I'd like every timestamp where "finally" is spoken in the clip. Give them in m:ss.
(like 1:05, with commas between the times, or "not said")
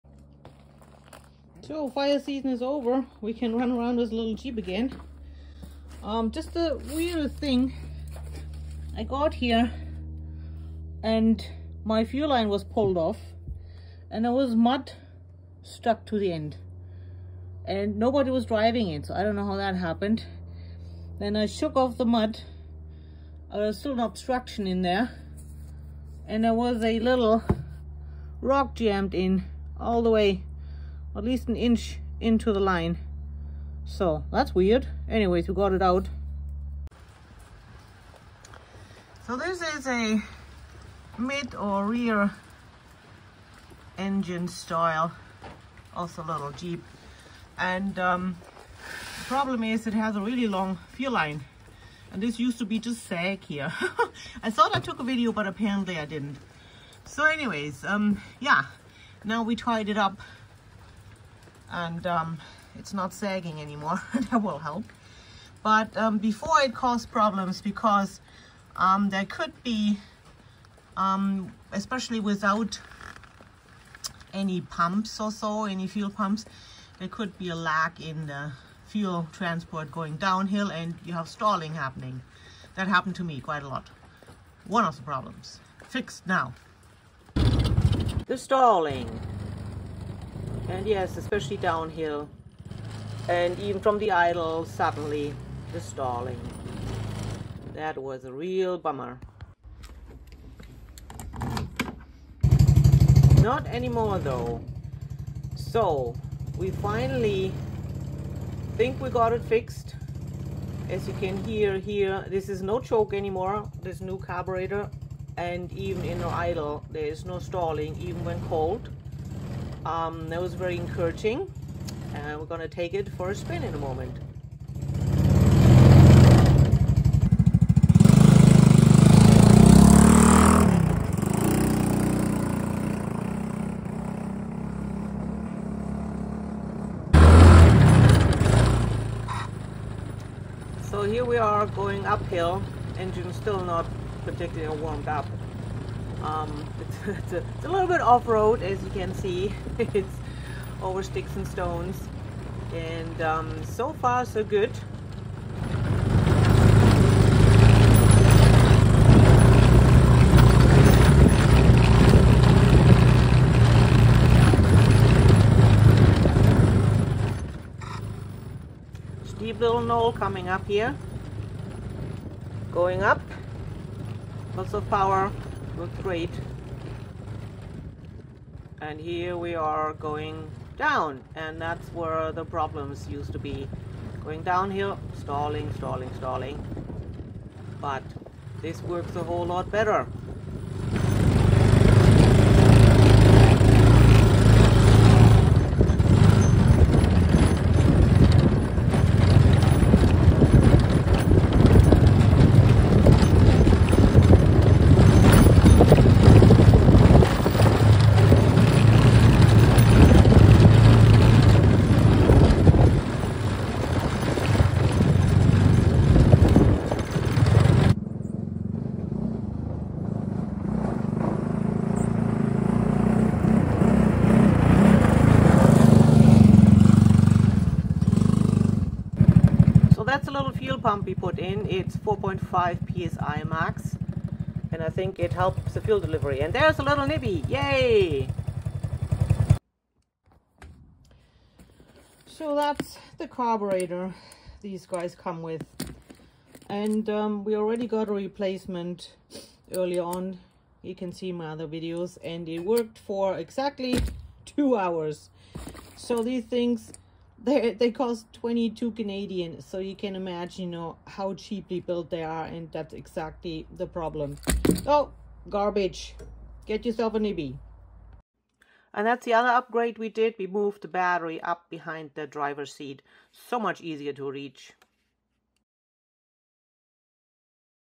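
1:46.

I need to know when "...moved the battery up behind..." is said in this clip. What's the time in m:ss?
4:30.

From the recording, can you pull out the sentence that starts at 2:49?
steep little knoll coming up here.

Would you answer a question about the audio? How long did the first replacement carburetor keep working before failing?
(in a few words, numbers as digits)
2 hours.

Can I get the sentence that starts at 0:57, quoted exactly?
So anyways, um, yeah, now we tied it up and um, it's not sagging anymore.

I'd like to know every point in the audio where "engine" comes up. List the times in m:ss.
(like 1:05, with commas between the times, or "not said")
0:43, 2:22.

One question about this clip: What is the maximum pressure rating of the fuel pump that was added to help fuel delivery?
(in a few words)
4.5 psi.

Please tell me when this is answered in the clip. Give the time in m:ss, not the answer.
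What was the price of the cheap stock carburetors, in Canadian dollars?
4:18.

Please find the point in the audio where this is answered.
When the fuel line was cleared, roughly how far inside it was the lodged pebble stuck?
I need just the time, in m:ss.
0:31.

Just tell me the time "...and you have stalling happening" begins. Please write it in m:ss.
1:20.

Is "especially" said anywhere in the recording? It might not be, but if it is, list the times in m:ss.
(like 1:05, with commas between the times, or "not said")
1:11, 1:31.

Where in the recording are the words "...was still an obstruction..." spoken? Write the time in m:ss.
0:23.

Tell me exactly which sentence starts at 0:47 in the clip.
And um, the problem is it has a really long fuel line.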